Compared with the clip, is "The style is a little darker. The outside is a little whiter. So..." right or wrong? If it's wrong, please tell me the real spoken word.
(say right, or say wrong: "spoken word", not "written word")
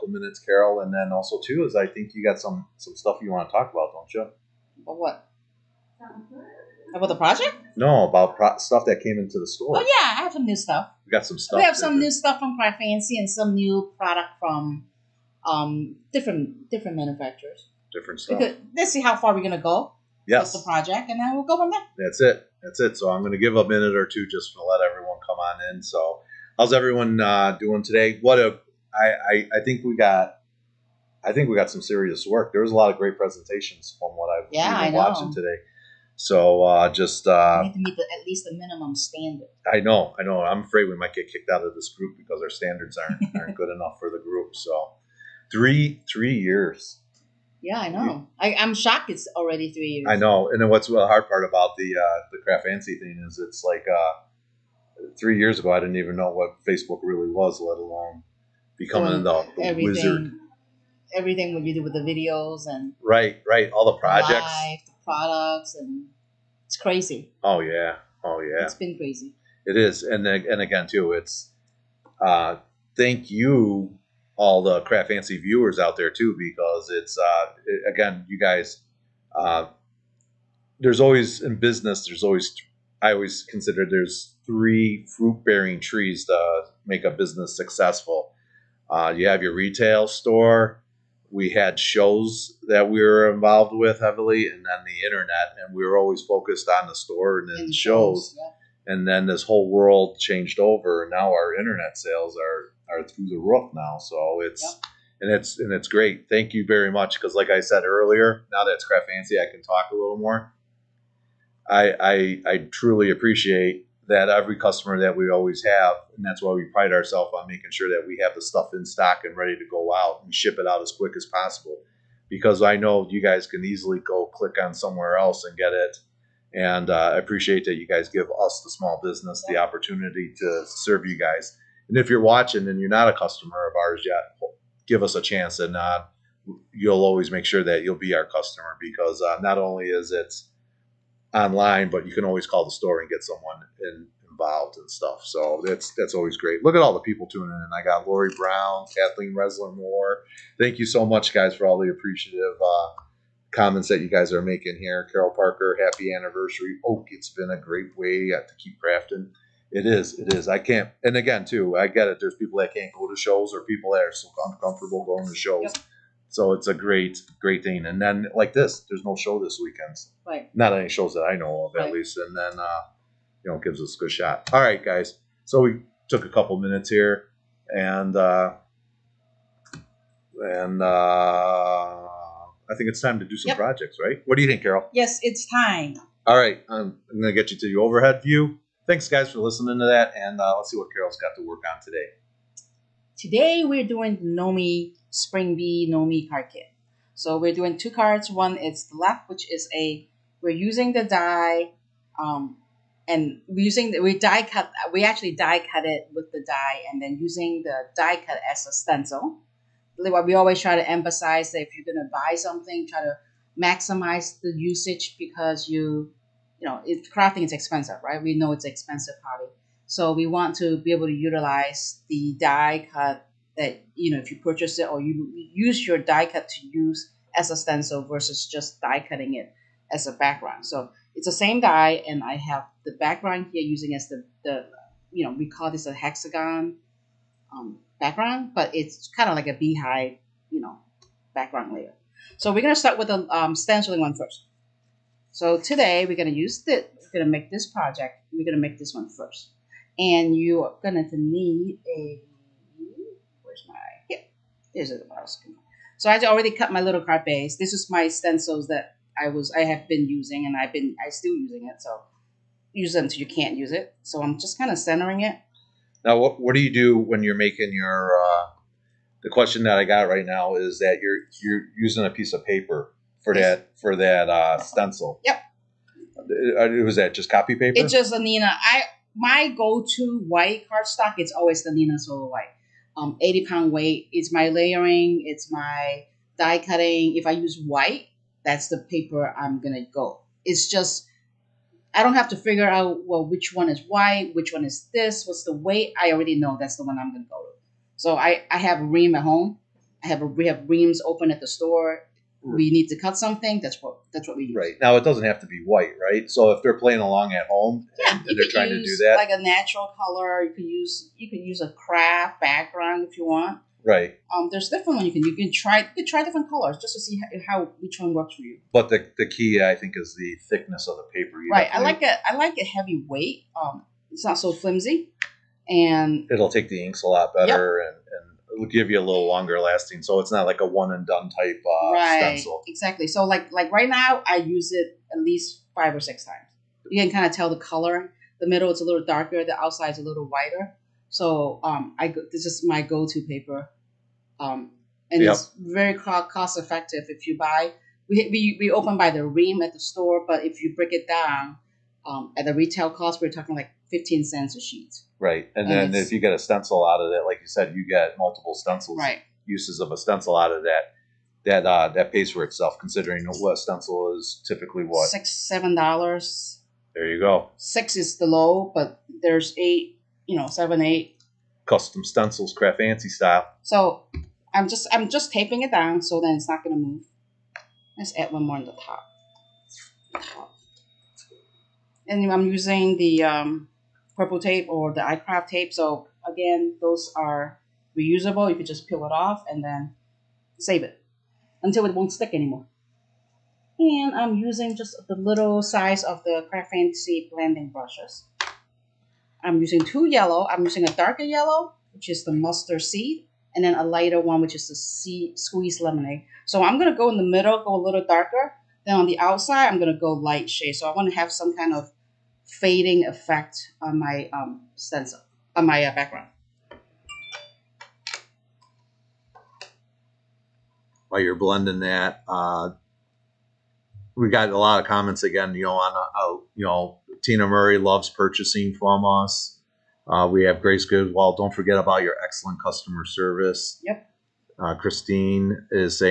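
wrong: "middle", not "style".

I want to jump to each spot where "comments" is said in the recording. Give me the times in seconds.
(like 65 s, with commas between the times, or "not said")
153 s, 424 s.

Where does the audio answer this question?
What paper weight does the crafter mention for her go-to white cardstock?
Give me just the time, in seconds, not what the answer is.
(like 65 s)
283 s.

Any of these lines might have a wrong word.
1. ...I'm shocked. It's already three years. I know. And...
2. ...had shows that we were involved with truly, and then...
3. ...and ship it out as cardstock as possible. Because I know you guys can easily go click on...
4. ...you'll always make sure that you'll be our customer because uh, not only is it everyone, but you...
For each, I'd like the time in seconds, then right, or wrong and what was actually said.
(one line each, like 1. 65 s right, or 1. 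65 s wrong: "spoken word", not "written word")
1. 48 s right
2. 91 s wrong: "heavily", not "truly"
3. 120 s wrong: "quick", not "cardstock"
4. 136 s wrong: "online", not "everyone".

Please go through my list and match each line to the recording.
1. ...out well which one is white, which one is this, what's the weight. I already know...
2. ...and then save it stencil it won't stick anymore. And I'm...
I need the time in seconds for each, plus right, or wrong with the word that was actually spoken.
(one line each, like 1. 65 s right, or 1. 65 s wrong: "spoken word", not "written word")
1. 292 s right
2. 389 s wrong: "until", not "stencil".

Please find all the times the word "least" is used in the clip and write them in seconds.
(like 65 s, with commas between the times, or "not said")
38 s, 171 s, 335 s.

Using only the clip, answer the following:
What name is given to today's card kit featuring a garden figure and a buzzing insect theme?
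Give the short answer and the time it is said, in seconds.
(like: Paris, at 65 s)
Gnomie Spring Bee, at 194 s.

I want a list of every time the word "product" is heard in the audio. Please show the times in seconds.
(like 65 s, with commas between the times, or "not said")
13 s, 65 s.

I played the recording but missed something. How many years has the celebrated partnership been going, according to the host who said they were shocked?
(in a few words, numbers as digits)
3.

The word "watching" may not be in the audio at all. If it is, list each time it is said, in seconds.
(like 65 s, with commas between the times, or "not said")
34 s, 132 s.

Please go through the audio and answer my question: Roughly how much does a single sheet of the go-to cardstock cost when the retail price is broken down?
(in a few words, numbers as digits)
15 cents.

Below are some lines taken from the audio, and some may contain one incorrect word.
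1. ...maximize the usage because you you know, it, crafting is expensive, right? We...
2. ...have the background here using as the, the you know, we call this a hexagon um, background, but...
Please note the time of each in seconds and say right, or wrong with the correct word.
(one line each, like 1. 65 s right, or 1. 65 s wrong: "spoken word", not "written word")
1. 213 s right
2. 232 s right.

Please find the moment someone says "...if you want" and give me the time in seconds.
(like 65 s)
313 s.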